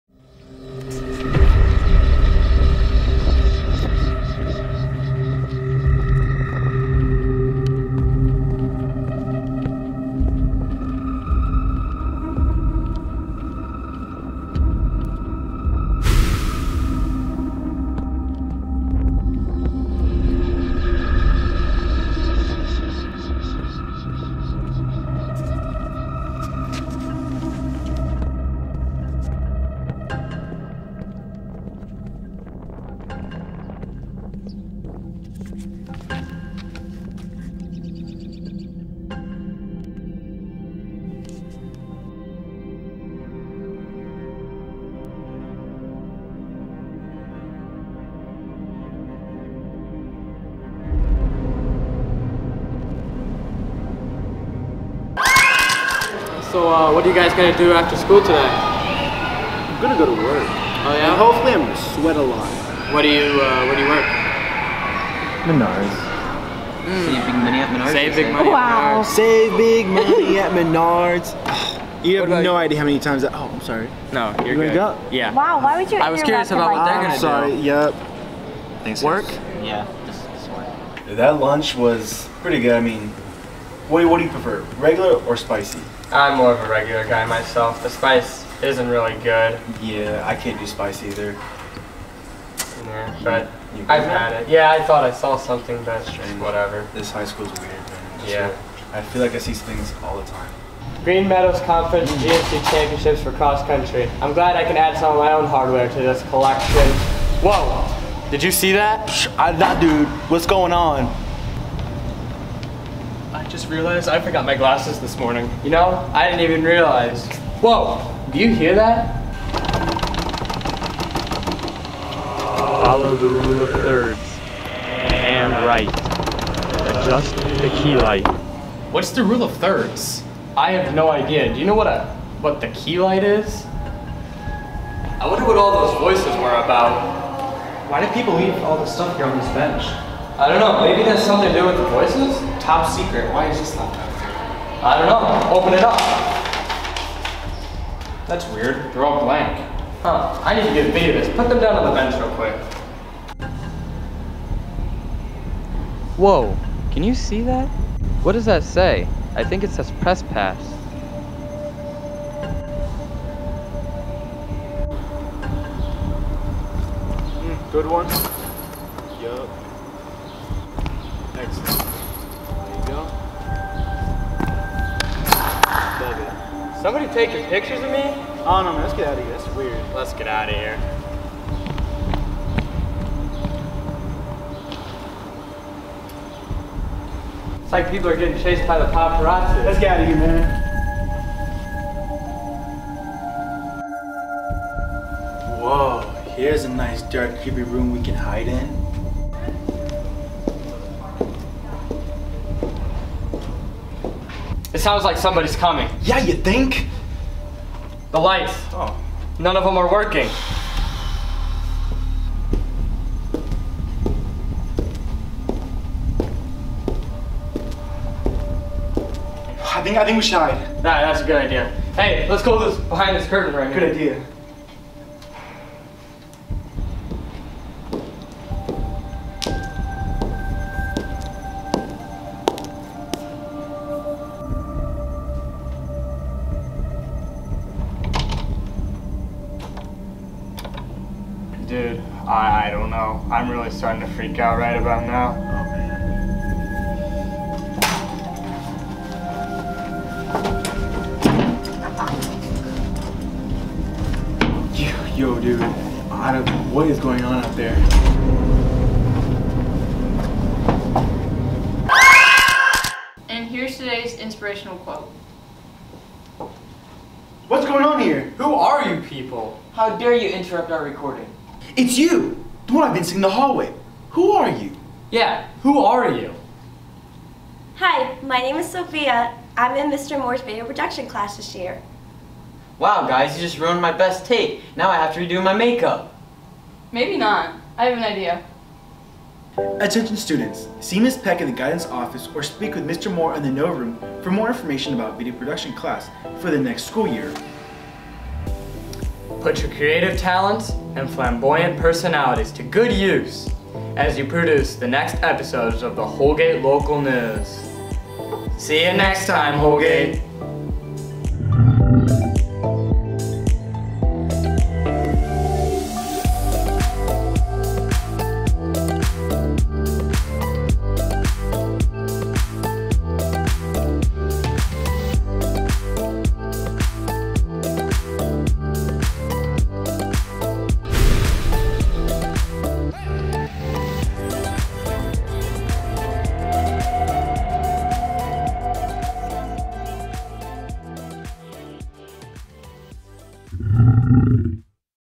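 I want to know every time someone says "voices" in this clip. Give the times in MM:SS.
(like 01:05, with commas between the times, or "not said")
02:15, 02:21.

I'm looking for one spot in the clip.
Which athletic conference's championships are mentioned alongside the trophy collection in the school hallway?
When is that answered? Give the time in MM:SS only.
01:41.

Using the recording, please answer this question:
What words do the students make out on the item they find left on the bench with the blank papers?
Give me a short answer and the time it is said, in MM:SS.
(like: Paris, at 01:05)
Press pass, at 02:40.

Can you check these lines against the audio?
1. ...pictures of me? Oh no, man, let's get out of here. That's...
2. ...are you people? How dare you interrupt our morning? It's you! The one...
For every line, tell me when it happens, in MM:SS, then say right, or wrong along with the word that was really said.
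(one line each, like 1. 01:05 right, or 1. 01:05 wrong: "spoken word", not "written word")
1. 02:57 right
2. 04:28 wrong: "recording", not "morning".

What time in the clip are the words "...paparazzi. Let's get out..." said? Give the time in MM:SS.
03:08.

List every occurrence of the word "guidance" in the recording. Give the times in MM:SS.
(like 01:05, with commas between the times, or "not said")
04:51.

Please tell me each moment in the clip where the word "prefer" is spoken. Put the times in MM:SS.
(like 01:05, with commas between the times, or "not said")
01:24.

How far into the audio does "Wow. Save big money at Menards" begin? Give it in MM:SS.
01:08.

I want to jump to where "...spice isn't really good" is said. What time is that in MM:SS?
01:27.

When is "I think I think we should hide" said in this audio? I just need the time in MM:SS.
03:39.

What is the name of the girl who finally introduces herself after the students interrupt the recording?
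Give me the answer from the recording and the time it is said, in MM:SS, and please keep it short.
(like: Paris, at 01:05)
Sophia, at 04:38.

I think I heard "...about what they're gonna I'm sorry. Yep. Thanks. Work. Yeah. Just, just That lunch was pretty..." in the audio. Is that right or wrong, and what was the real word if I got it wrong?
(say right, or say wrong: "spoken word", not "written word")
right.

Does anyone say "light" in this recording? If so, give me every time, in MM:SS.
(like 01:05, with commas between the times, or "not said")
02:07, 02:13, 03:28.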